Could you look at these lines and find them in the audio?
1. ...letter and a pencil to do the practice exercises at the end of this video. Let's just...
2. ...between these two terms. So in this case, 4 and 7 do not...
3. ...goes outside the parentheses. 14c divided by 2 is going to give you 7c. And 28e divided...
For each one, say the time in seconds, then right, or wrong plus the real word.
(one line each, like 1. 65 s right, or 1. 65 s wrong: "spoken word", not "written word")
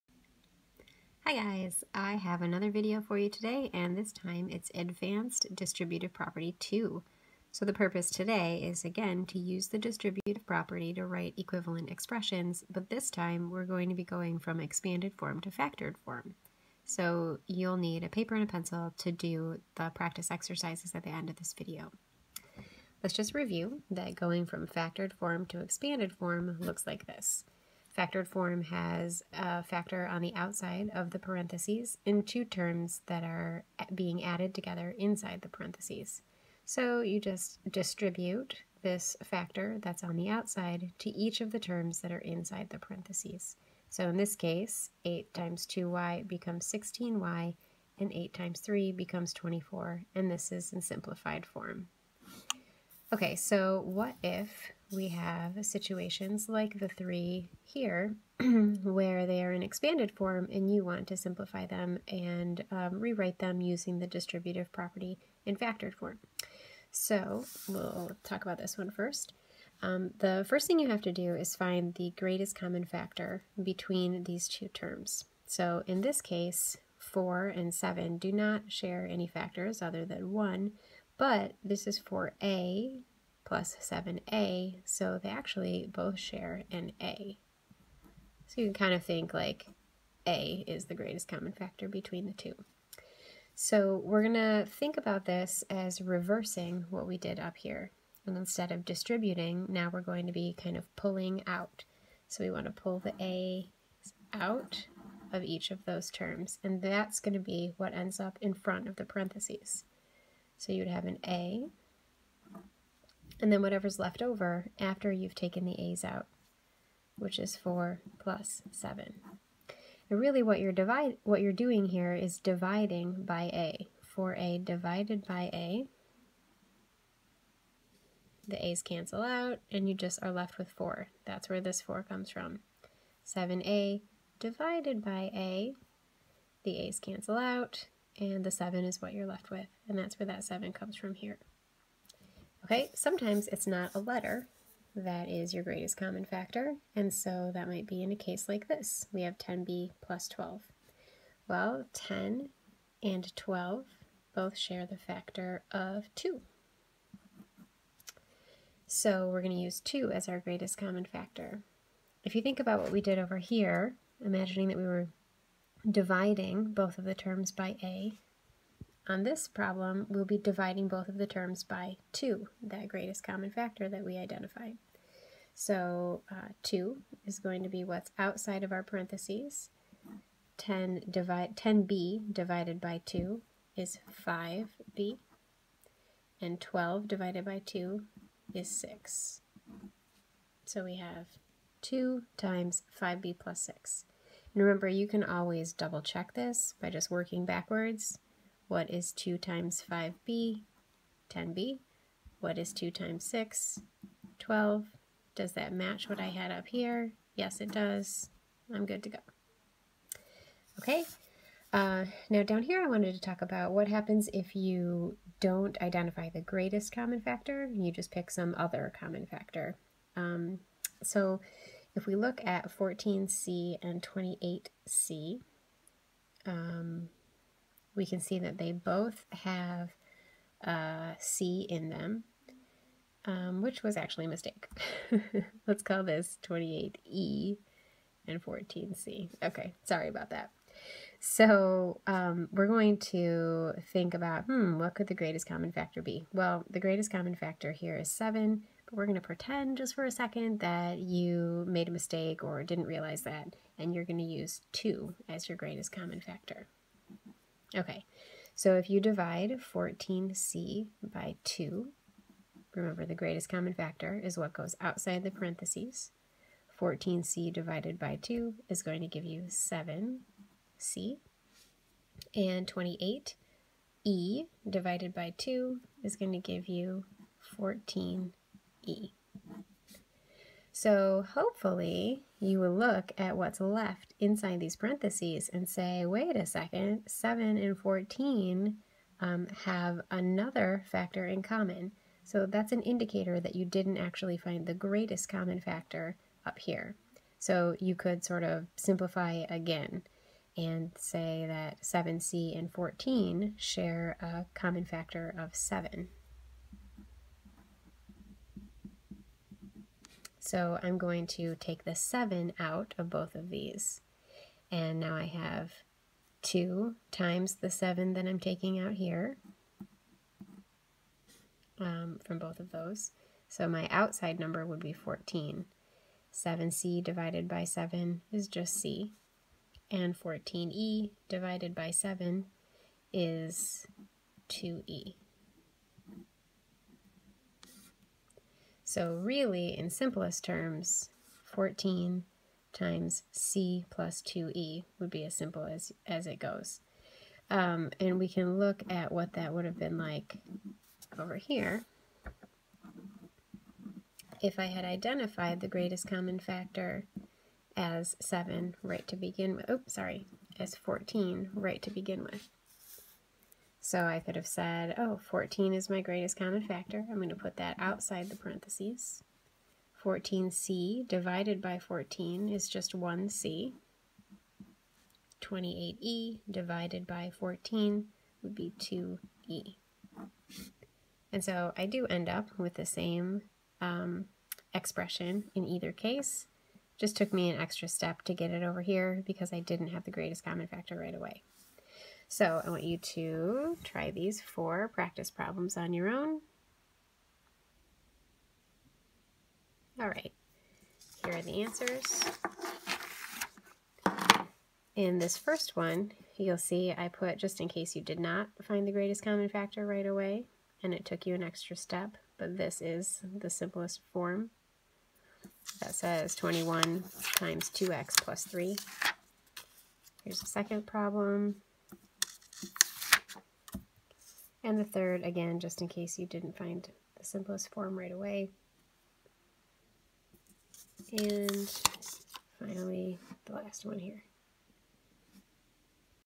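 1. 18 s wrong: "paper", not "letter"
2. 73 s right
3. 264 s right.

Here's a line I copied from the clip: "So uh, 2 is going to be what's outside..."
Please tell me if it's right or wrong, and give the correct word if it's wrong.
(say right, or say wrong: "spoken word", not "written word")
right.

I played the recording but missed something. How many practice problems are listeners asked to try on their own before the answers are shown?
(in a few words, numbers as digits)
4.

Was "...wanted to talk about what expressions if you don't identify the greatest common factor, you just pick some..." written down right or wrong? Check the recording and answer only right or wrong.
wrong.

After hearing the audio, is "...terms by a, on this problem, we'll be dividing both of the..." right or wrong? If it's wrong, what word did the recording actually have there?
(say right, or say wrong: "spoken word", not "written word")
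right.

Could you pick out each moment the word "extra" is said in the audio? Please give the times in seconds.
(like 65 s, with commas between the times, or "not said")
387 s, 411 s.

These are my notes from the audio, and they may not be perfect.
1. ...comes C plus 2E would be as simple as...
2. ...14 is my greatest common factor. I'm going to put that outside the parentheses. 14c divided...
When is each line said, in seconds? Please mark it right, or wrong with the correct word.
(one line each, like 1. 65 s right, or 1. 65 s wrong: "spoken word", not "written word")
1. 342 s wrong: "times", not "comes"
2. 365 s right.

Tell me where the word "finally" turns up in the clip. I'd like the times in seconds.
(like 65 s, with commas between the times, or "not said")
432 s.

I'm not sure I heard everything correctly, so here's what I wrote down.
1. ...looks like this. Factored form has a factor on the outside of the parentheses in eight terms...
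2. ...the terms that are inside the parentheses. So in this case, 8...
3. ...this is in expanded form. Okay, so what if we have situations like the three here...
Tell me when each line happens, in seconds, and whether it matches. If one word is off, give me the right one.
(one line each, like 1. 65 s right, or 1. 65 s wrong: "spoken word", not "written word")
1. 26 s wrong: "two", not "eight"
2. 41 s right
3. 50 s wrong: "simplified", not "expanded".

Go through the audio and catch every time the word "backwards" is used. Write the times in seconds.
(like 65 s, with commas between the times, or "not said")
197 s.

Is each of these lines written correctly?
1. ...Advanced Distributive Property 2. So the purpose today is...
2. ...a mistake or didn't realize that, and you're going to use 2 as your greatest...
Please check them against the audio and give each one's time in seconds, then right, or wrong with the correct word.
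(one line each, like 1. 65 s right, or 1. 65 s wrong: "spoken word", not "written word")
1. 4 s right
2. 251 s right.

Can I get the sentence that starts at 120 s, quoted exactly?
And really what you're, divide, what you're doing here is dividing by a.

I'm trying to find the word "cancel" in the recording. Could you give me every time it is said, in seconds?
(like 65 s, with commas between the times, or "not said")
128 s, 136 s.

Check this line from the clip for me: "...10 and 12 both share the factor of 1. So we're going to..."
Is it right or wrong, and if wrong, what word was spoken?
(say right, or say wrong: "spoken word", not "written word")
wrong: "2", not "1".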